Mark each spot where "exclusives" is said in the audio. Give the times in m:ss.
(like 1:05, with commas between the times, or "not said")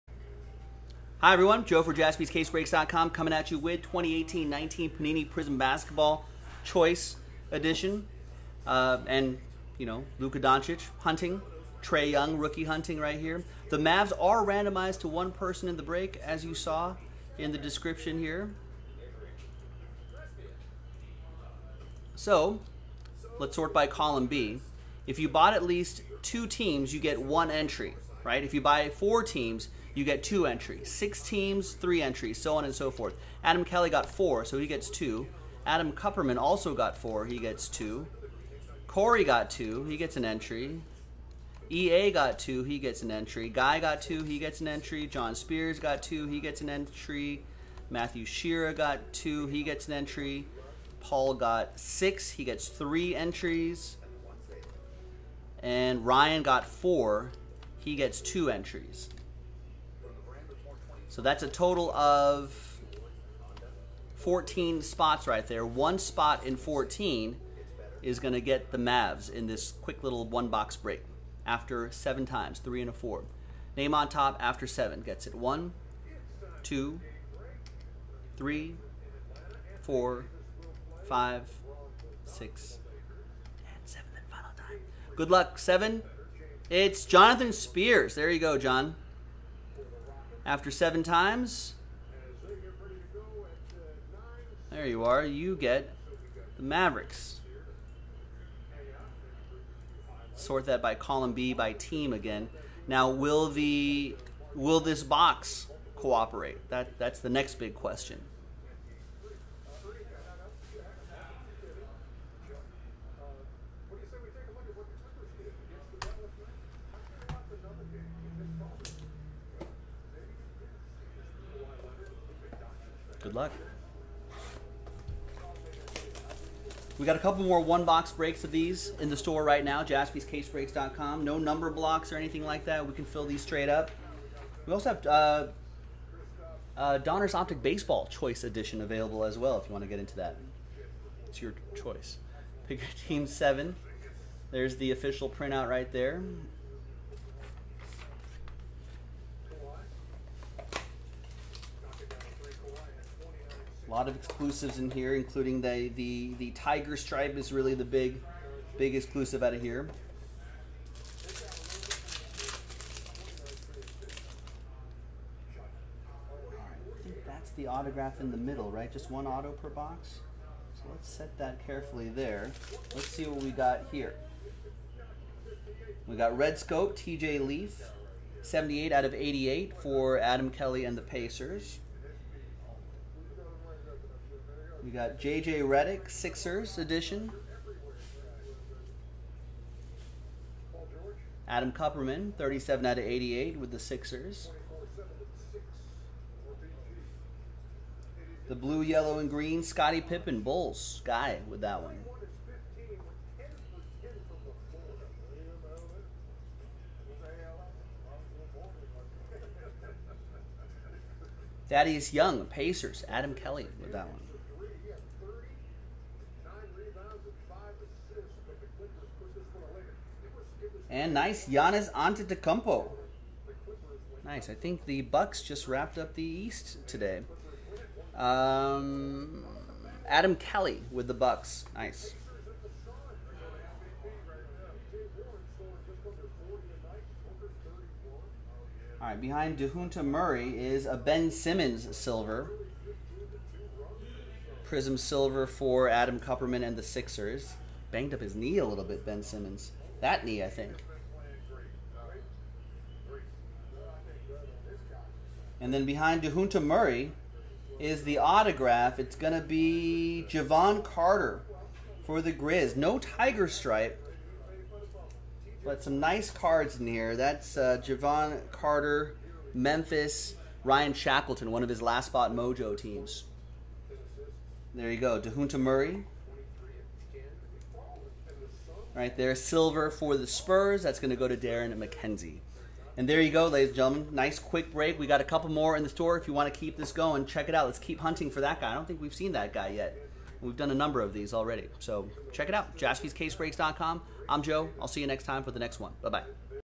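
2:34, 2:38.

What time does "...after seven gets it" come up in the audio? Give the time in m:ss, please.
1:14.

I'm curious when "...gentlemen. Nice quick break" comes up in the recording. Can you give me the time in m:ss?
4:43.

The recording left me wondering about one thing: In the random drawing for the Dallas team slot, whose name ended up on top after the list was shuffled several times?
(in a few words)
Jonathan Spears.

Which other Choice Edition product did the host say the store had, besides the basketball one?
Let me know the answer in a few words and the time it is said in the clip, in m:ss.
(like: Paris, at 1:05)
Donruss Optic Baseball, at 2:16.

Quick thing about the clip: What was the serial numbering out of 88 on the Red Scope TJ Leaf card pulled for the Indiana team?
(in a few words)
78.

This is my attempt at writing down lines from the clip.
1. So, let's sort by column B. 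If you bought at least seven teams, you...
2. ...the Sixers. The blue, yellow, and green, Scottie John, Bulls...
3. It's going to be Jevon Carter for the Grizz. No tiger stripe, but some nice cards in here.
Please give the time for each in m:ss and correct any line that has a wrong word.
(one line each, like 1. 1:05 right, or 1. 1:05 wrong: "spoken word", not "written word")
1. 0:22 wrong: "two", not "seven"
2. 3:13 wrong: "Pippen", not "John"
3. 4:18 right.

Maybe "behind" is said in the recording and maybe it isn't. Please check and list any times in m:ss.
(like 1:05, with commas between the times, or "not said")
3:59, 4:15.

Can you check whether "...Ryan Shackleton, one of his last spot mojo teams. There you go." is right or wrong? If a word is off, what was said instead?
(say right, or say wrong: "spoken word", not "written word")
right.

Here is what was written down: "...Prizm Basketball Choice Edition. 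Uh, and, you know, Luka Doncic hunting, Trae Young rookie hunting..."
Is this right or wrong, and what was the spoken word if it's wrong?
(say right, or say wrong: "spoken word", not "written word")
right.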